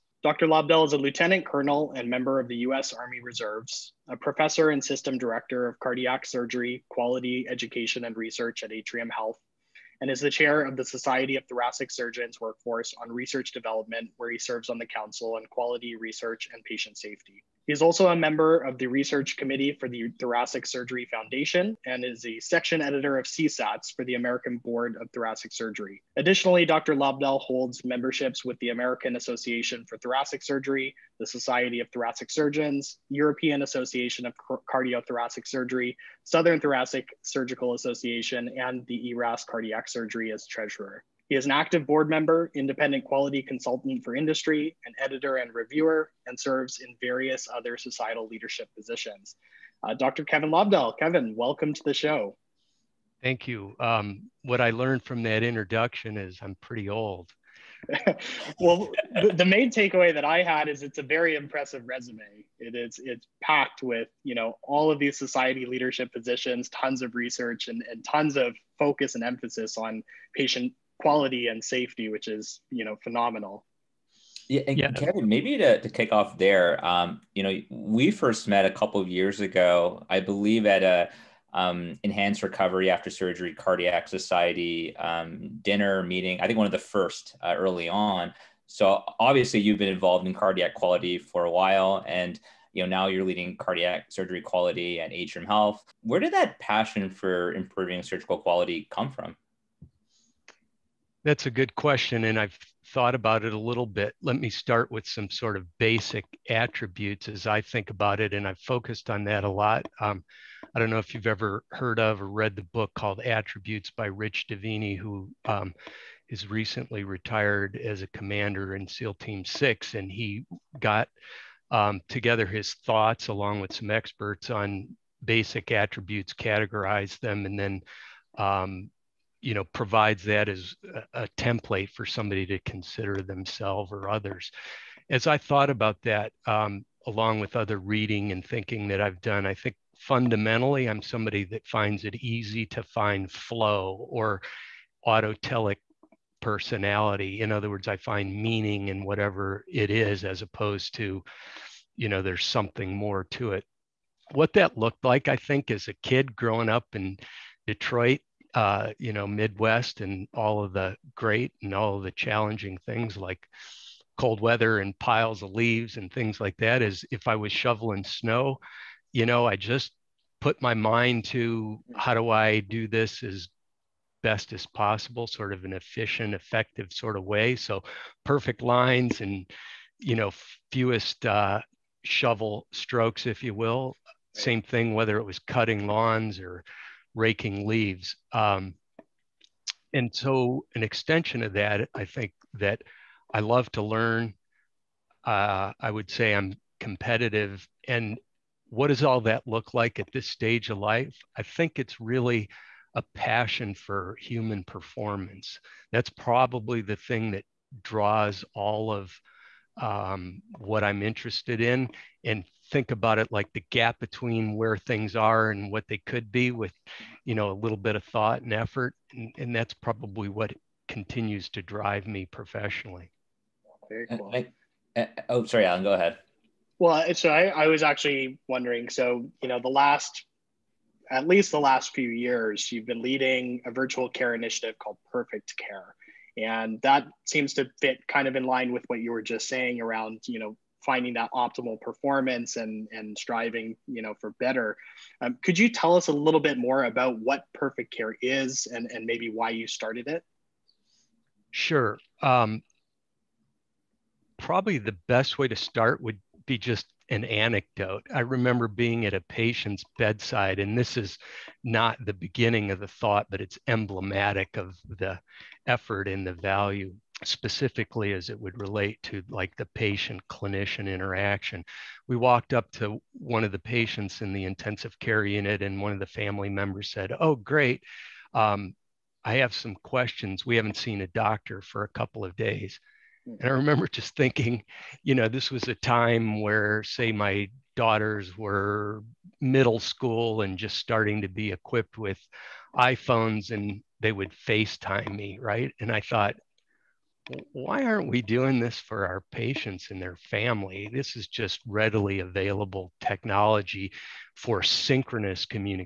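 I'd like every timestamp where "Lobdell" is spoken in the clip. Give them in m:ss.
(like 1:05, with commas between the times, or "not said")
0:00, 0:26, 0:50.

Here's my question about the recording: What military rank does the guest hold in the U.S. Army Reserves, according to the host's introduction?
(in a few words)
Lieutenant colonel.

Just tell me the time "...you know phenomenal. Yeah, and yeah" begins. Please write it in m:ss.
1:12.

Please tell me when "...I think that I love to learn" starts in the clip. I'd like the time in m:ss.
3:11.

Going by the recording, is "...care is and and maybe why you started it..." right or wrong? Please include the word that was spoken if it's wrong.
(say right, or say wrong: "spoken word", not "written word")
right.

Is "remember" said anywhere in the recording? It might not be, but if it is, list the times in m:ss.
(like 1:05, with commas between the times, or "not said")
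4:18, 4:43.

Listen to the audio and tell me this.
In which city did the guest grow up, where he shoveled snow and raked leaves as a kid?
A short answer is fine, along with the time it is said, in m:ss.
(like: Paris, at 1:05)
Detroit, at 2:37.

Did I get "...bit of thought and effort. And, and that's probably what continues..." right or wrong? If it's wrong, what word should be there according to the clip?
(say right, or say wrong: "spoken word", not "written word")
right.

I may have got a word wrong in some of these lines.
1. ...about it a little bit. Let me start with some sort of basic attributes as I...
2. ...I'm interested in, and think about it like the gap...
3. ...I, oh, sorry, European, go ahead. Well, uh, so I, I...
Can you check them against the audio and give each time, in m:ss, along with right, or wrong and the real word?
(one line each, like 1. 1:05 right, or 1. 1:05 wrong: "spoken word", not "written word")
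1. 1:43 right
2. 3:30 right
3. 3:44 wrong: "Alan", not "European".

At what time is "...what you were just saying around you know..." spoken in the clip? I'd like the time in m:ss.
3:58.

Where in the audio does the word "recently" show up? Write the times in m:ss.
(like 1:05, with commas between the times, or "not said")
1:56.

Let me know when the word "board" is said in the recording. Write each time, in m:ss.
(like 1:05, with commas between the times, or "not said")
0:24, 0:41.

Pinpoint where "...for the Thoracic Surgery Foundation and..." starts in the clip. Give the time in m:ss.
0:19.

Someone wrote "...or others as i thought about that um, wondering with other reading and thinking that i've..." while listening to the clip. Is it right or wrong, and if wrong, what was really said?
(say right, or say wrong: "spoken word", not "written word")
wrong: "along", not "wondering".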